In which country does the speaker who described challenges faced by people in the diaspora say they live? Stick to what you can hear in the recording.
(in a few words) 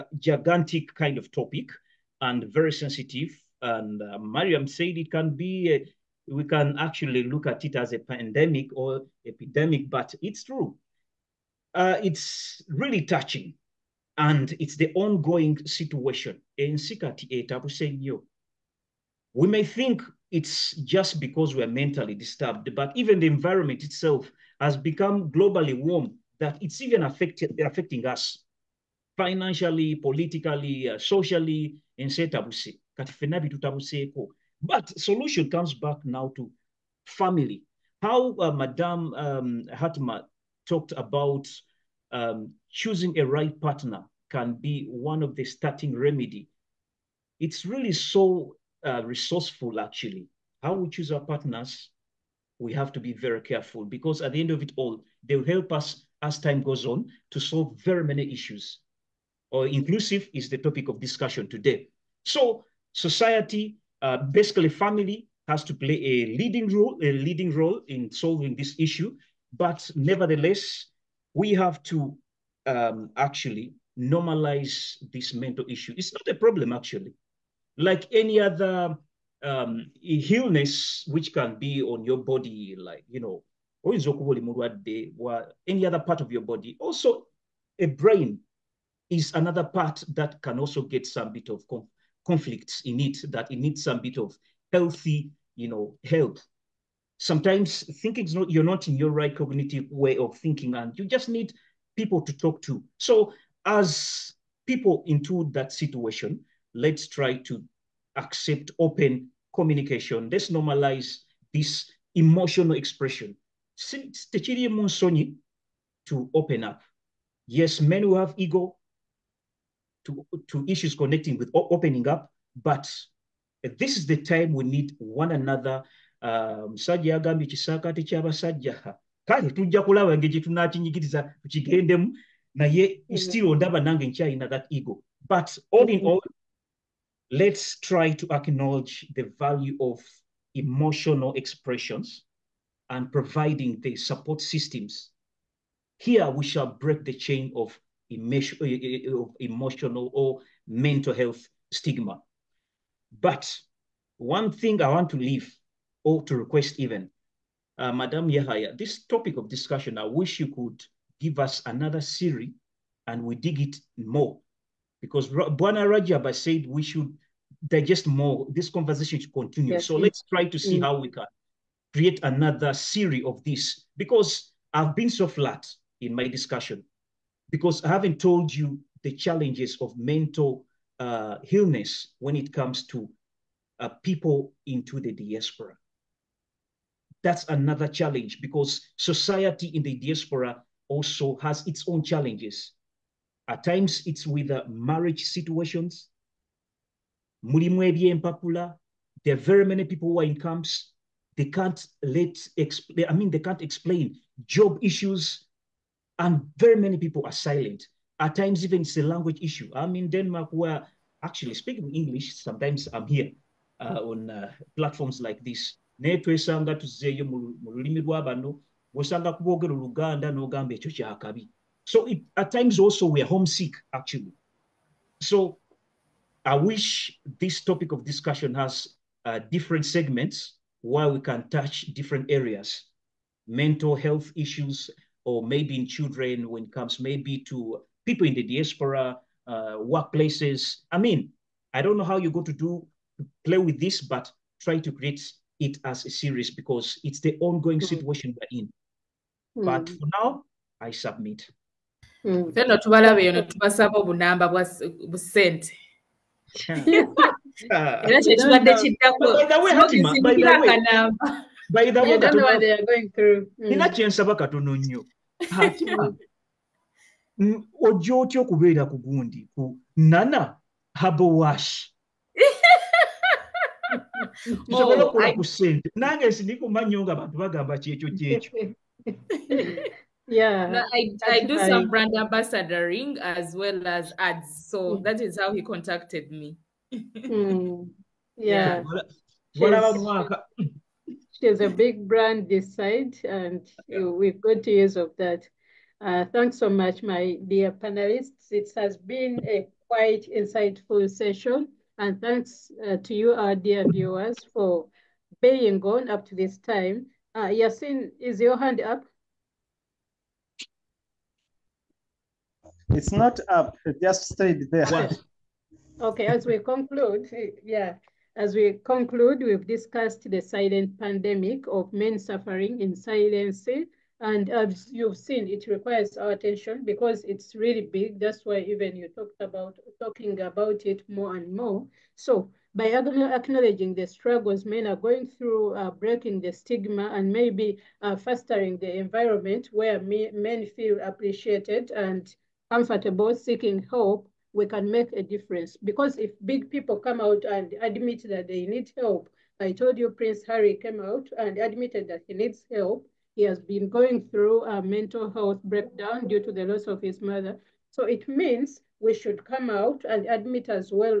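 Denmark.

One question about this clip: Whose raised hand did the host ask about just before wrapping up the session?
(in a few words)
Yasin.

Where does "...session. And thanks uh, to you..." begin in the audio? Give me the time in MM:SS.
05:01.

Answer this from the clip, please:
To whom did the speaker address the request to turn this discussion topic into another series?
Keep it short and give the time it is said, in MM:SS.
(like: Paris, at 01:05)
Madam Yahaya, at 02:37.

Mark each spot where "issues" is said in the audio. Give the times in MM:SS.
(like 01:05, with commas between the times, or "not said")
00:58, 01:08, 01:15, 02:00, 03:24, 03:29, 03:54.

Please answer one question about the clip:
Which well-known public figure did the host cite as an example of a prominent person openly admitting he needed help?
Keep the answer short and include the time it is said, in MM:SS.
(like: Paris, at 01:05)
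Prince Harry, at 05:50.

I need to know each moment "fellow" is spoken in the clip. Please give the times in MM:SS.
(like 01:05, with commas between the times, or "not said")
not said.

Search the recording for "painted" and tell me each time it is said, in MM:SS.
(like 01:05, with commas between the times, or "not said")
not said.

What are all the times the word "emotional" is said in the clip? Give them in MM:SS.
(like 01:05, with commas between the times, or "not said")
01:52, 02:20, 02:29.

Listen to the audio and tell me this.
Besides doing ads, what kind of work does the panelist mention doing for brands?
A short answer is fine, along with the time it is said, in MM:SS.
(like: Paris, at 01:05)
Brand ambassadoring, at 04:41.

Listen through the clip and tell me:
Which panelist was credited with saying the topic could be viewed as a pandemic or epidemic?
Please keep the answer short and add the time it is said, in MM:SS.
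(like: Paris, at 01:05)
Mariam, at 00:04.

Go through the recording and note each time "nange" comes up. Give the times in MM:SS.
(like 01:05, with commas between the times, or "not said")
02:13, 04:36.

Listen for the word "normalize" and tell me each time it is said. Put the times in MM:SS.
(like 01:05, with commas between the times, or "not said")
01:13, 01:50.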